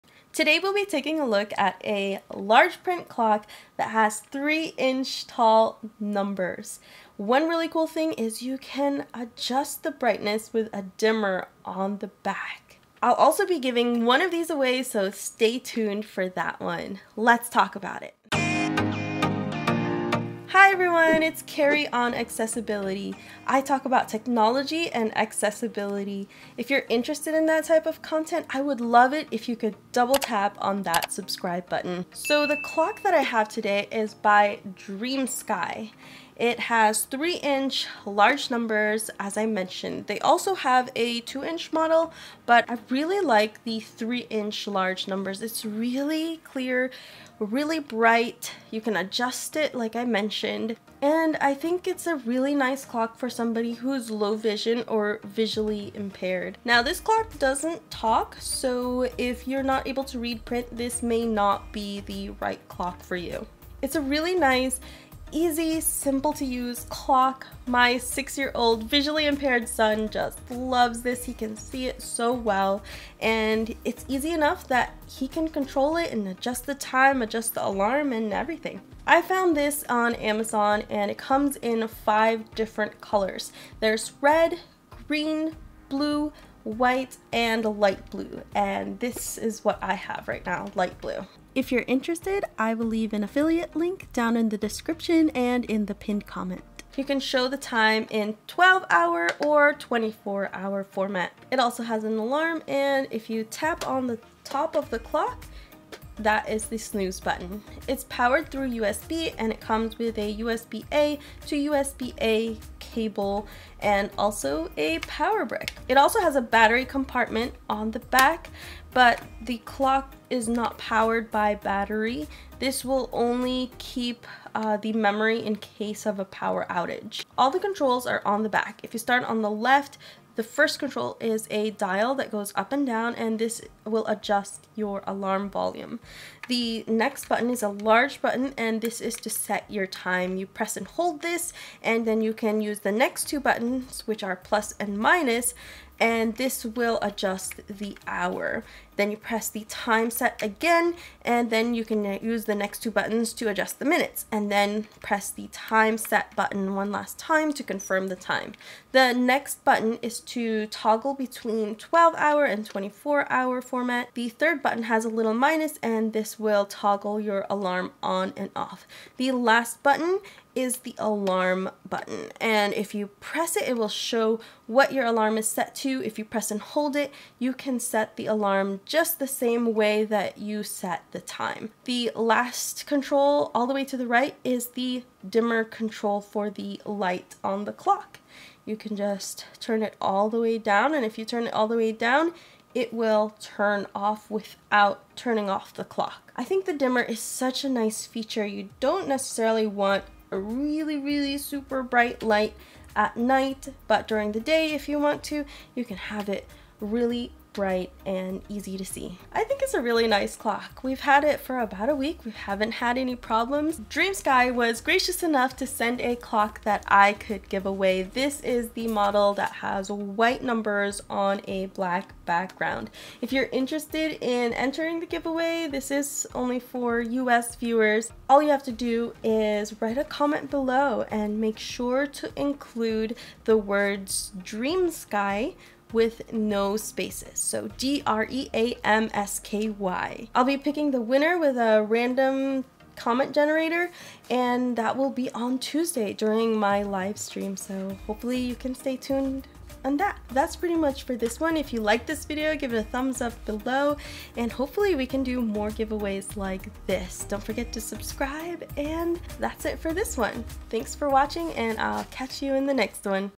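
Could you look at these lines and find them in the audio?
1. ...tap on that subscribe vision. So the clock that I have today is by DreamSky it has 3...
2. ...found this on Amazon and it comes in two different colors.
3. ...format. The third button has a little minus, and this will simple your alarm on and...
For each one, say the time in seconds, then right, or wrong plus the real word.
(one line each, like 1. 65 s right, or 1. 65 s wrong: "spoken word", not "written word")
1. 30 s wrong: "button", not "vision"
2. 79 s wrong: "five", not "two"
3. 163 s wrong: "toggle", not "simple".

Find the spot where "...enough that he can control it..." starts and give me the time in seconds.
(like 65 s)
74 s.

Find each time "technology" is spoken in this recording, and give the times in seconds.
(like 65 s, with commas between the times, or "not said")
24 s.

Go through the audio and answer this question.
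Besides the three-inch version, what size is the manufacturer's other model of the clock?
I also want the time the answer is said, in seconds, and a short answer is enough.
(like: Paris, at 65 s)
2 inch, at 41 s.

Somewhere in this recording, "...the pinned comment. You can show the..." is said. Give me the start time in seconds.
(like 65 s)
95 s.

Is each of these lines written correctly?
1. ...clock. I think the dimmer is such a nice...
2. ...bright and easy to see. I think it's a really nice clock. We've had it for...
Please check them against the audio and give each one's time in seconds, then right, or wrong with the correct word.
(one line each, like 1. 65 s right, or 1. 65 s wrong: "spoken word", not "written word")
1. 195 s right
2. 207 s right.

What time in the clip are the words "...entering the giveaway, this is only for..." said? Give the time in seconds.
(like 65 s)
224 s.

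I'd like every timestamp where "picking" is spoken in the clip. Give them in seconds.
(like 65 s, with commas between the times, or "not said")
240 s.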